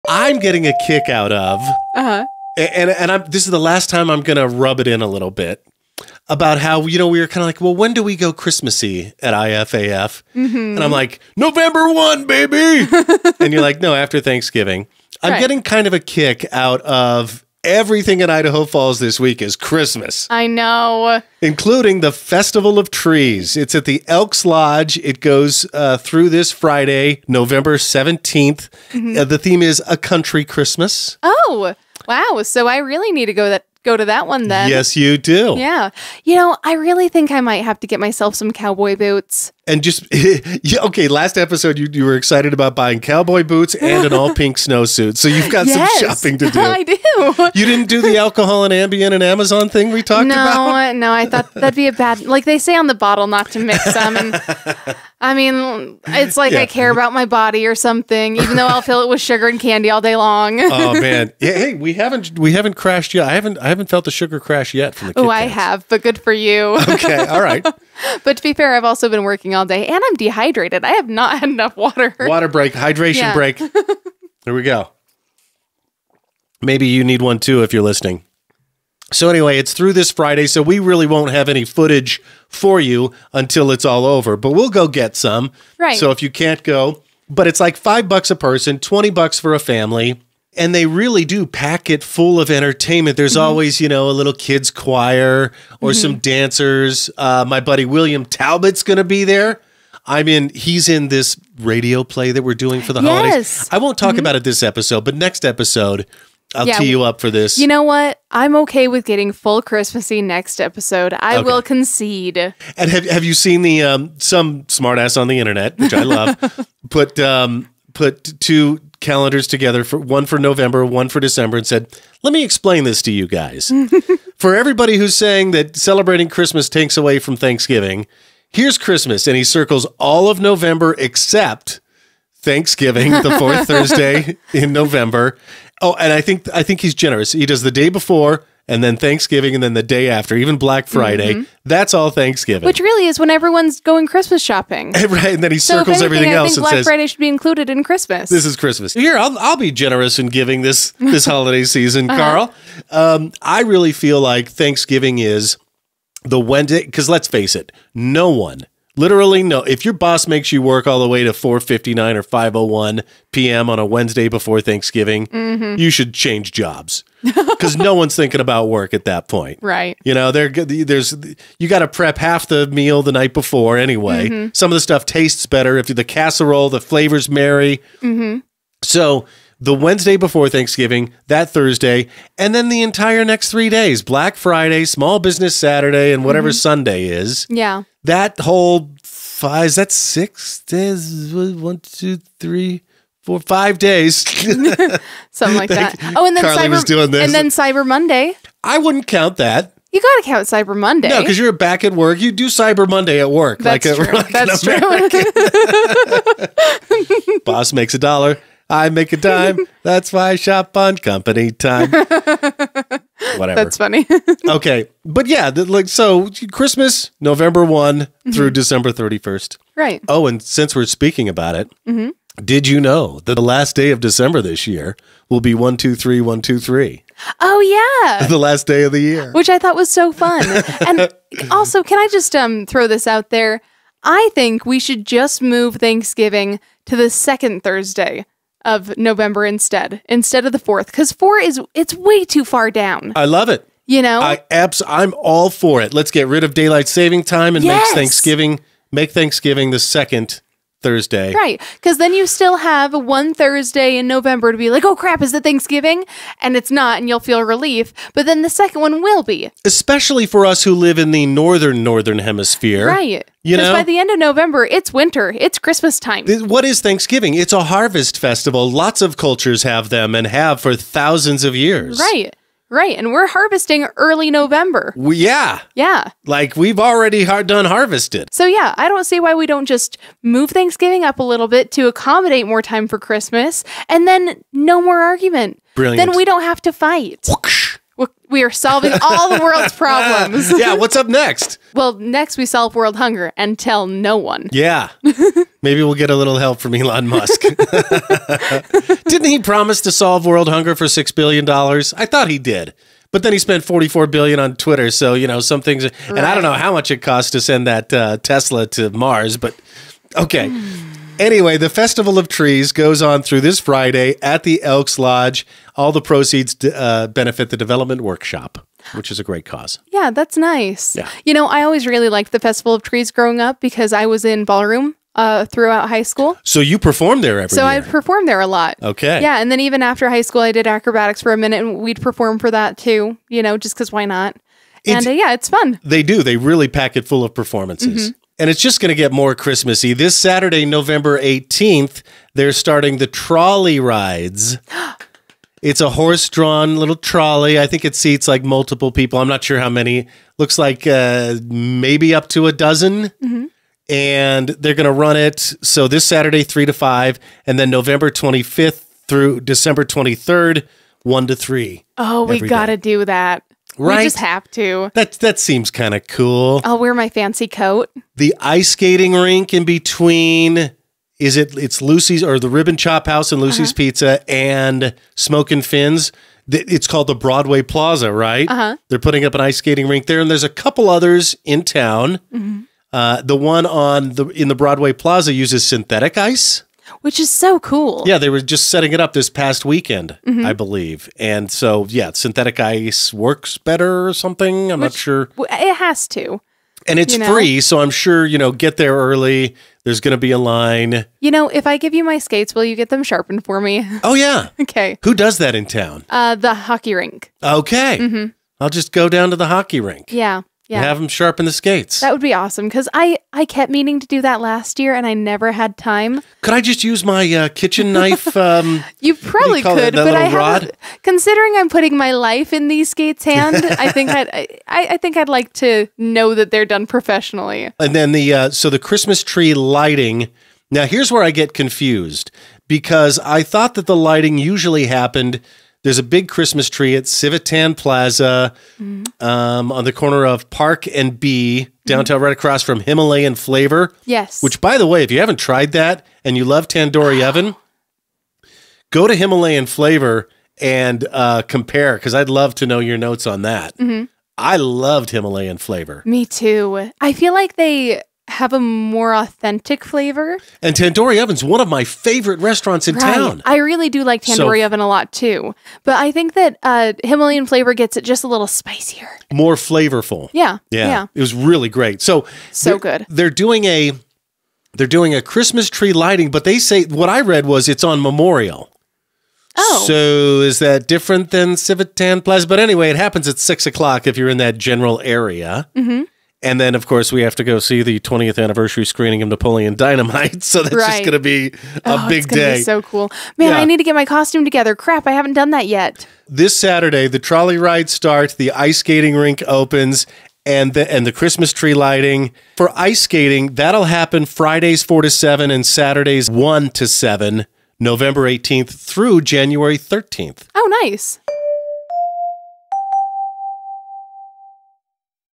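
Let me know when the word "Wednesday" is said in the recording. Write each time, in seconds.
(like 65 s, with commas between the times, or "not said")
156 s, 163 s, 179 s.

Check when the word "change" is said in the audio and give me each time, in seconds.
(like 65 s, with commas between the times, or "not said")
166 s.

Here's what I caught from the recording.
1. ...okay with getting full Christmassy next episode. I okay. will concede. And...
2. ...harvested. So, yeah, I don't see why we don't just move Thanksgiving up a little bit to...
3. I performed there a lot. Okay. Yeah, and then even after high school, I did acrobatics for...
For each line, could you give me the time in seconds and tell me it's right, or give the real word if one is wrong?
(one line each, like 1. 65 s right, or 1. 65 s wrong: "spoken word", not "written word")
1. 108 s right
2. 277 s right
3. 327 s right.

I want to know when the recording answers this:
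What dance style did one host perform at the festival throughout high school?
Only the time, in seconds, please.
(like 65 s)
324 s.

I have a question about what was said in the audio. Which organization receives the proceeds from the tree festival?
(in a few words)
The Development Workshop.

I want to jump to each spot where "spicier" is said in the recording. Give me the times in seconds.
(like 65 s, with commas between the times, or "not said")
468 s.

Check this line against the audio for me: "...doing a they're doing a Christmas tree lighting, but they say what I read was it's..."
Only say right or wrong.
right.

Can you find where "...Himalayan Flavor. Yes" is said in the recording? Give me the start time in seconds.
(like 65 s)
442 s.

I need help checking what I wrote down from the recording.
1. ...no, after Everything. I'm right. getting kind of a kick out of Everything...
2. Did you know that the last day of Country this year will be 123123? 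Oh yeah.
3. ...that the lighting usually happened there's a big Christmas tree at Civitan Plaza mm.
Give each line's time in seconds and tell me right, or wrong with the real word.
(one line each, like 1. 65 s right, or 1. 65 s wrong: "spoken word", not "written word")
1. 13 s wrong: "Thanksgiving", not "Everything"
2. 222 s wrong: "December", not "Country"
3. 433 s right.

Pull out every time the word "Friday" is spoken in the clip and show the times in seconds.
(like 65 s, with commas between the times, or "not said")
26 s, 80 s, 140 s, 146 s, 184 s, 313 s, 504 s.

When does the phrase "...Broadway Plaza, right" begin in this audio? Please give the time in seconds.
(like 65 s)
377 s.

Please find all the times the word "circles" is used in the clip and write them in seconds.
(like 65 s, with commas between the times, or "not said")
129 s, 145 s.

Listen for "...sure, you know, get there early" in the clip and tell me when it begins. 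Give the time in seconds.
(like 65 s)
397 s.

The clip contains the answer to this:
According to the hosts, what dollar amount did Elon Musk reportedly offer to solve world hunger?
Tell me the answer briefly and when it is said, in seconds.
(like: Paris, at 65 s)
6 billion dollars, at 300 s.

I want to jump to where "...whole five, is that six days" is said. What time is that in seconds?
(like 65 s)
188 s.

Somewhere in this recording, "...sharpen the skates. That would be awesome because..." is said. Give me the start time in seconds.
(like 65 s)
411 s.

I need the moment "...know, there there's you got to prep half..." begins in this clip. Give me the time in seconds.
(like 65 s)
170 s.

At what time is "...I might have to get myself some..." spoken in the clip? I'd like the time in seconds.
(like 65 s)
37 s.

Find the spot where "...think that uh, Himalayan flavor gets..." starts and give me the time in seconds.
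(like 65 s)
466 s.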